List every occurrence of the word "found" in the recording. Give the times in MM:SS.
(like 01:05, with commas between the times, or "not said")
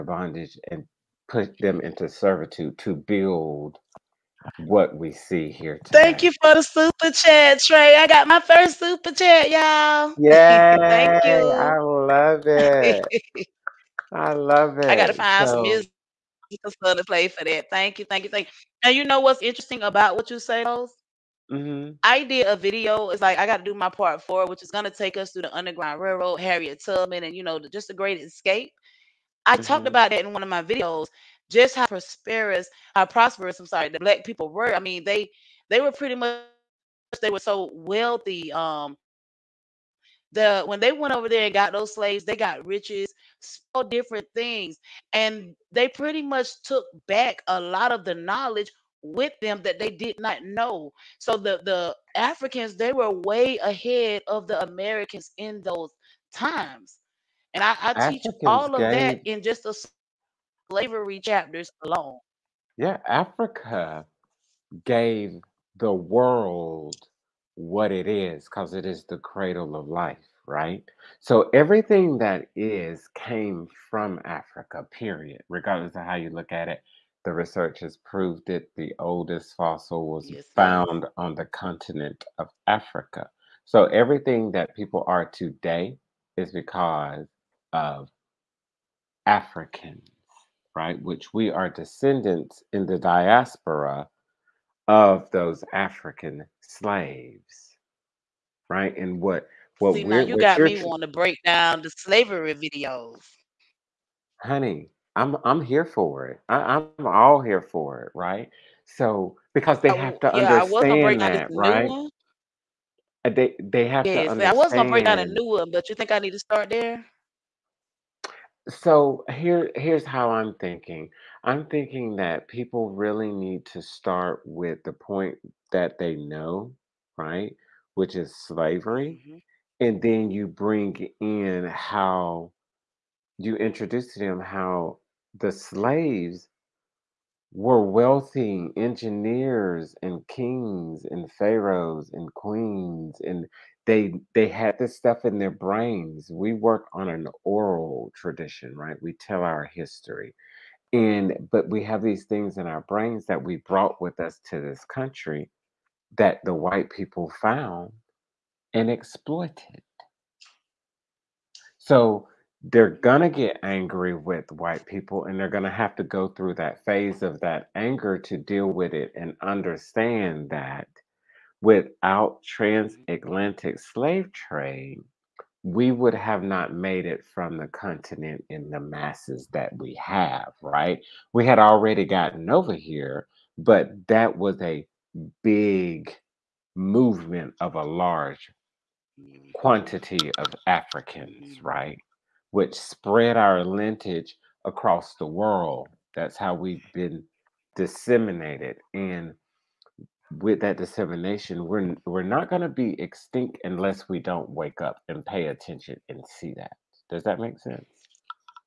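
01:20, 02:37.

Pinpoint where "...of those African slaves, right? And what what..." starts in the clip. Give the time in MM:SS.
01:34.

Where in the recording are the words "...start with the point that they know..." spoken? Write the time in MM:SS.
02:03.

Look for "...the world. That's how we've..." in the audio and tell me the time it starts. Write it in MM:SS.
03:15.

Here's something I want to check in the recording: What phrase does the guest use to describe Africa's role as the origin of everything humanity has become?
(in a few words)
the cradle of life.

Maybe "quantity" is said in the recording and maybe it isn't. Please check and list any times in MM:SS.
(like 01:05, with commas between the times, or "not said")
03:09.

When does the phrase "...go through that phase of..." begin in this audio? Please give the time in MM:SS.
02:46.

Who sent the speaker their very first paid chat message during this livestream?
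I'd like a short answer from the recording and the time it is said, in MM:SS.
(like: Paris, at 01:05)
Trey, at 00:07.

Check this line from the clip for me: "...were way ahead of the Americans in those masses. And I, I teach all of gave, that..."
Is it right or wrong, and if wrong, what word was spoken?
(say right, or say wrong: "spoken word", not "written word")
wrong: "times", not "masses".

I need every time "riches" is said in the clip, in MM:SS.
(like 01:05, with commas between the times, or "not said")
00:42.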